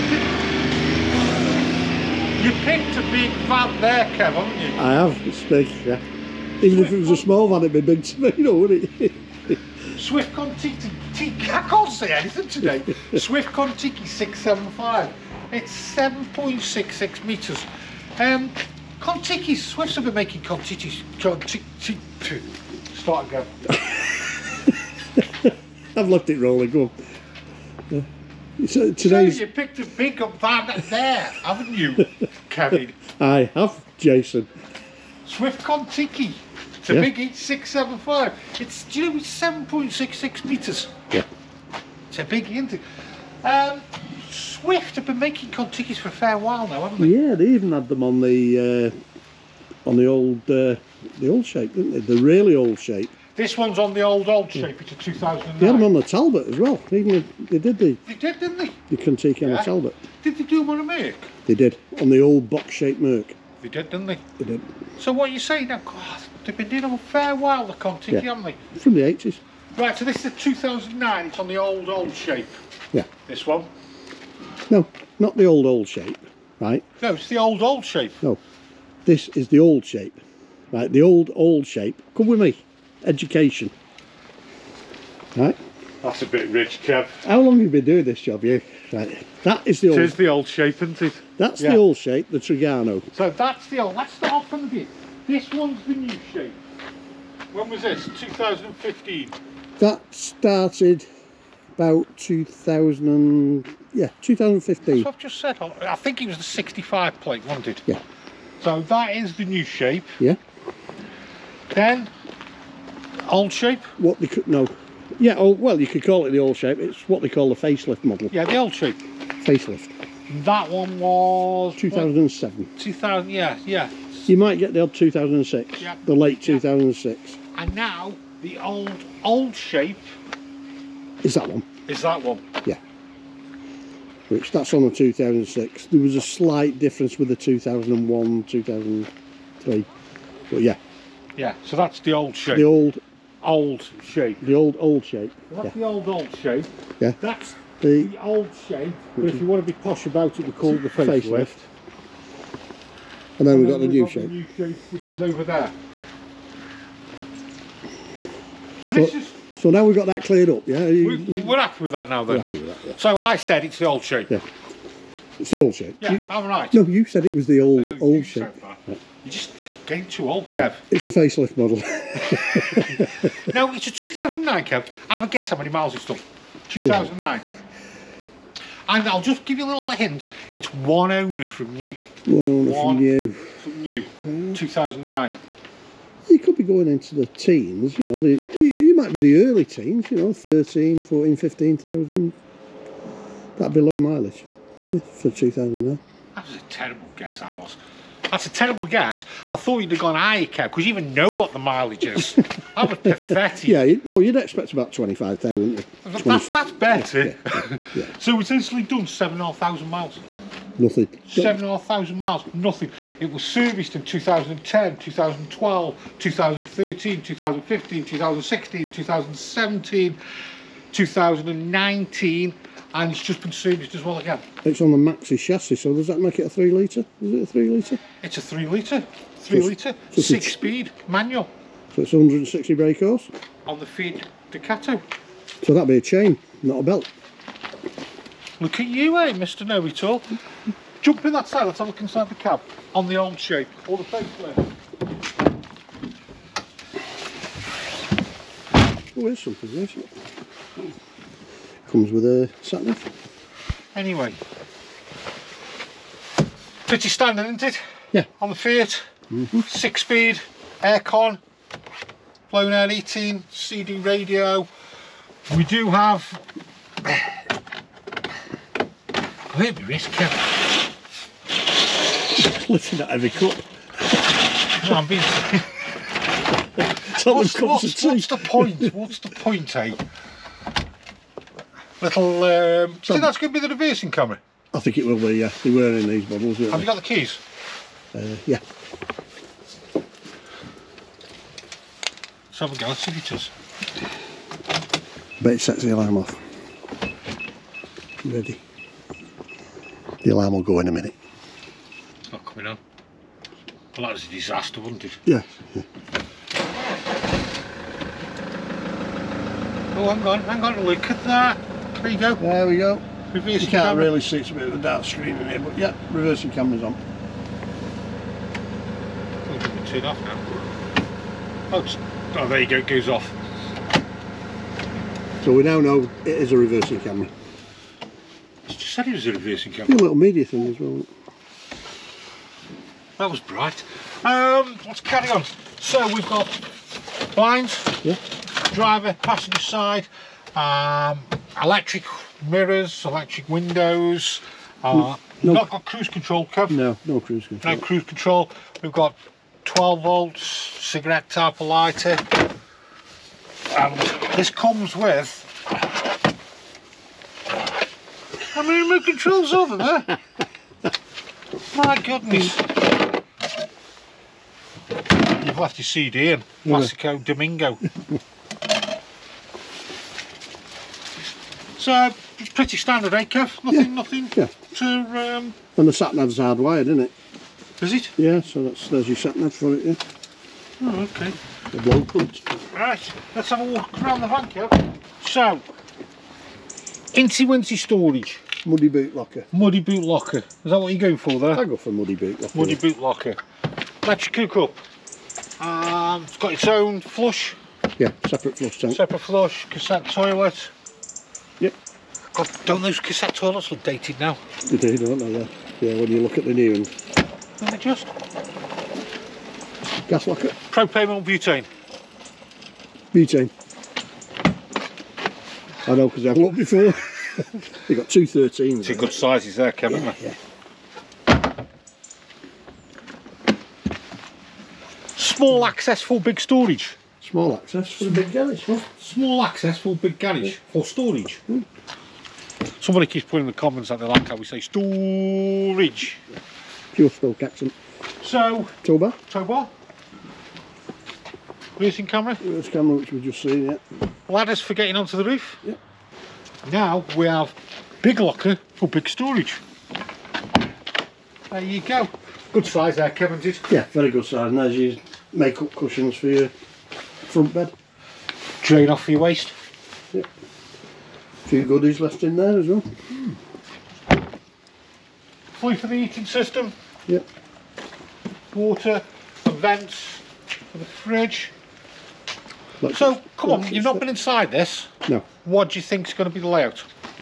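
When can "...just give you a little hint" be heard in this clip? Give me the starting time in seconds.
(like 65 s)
179 s.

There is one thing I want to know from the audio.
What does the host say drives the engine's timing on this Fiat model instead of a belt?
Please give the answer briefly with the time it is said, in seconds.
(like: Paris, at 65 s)
A chain, at 236 s.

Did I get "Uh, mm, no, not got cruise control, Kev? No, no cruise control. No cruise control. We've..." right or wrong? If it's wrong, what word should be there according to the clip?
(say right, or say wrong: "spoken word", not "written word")
right.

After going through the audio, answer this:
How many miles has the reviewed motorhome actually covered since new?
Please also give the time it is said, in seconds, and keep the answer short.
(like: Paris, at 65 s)
7,500, at 209 s.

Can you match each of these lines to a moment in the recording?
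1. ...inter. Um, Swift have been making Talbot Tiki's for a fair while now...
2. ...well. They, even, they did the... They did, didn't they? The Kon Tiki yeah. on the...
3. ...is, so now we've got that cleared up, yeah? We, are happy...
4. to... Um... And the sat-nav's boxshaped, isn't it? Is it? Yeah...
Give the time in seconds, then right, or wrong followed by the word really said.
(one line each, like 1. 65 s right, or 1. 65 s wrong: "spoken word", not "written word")
1. 42 s wrong: "Kon", not "Talbot"
2. 56 s right
3. 158 s right
4. 374 s wrong: "hardwired", not "boxshaped".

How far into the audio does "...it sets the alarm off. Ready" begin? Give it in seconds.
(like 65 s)
295 s.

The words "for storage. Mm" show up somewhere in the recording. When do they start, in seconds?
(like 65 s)
430 s.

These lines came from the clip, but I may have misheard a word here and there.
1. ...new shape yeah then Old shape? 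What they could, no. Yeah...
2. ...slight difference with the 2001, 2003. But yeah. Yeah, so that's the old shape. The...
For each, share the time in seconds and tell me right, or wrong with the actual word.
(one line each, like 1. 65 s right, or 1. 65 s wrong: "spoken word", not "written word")
1. 109 s right
2. 136 s right.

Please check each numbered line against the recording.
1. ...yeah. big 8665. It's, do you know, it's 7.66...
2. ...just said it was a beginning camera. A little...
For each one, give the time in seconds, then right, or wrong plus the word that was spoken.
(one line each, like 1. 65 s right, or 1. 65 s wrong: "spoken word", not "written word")
1. 36 s wrong: "8675", not "8665"
2. 328 s wrong: "reversing", not "beginning".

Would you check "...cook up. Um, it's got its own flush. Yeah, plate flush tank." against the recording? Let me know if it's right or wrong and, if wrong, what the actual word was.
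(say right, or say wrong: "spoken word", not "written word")
wrong: "separate", not "plate".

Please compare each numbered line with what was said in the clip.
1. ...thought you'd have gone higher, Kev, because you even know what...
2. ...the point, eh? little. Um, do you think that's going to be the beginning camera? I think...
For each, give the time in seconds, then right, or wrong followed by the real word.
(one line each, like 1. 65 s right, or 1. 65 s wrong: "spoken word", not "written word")
1. 199 s right
2. 279 s wrong: "reversing", not "beginning".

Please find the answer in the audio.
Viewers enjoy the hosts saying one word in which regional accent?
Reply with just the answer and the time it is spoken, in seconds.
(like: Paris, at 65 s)
Stoke, at 437 s.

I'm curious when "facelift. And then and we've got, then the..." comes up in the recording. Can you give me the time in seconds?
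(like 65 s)
151 s.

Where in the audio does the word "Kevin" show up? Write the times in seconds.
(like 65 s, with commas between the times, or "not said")
32 s, 419 s, 453 s.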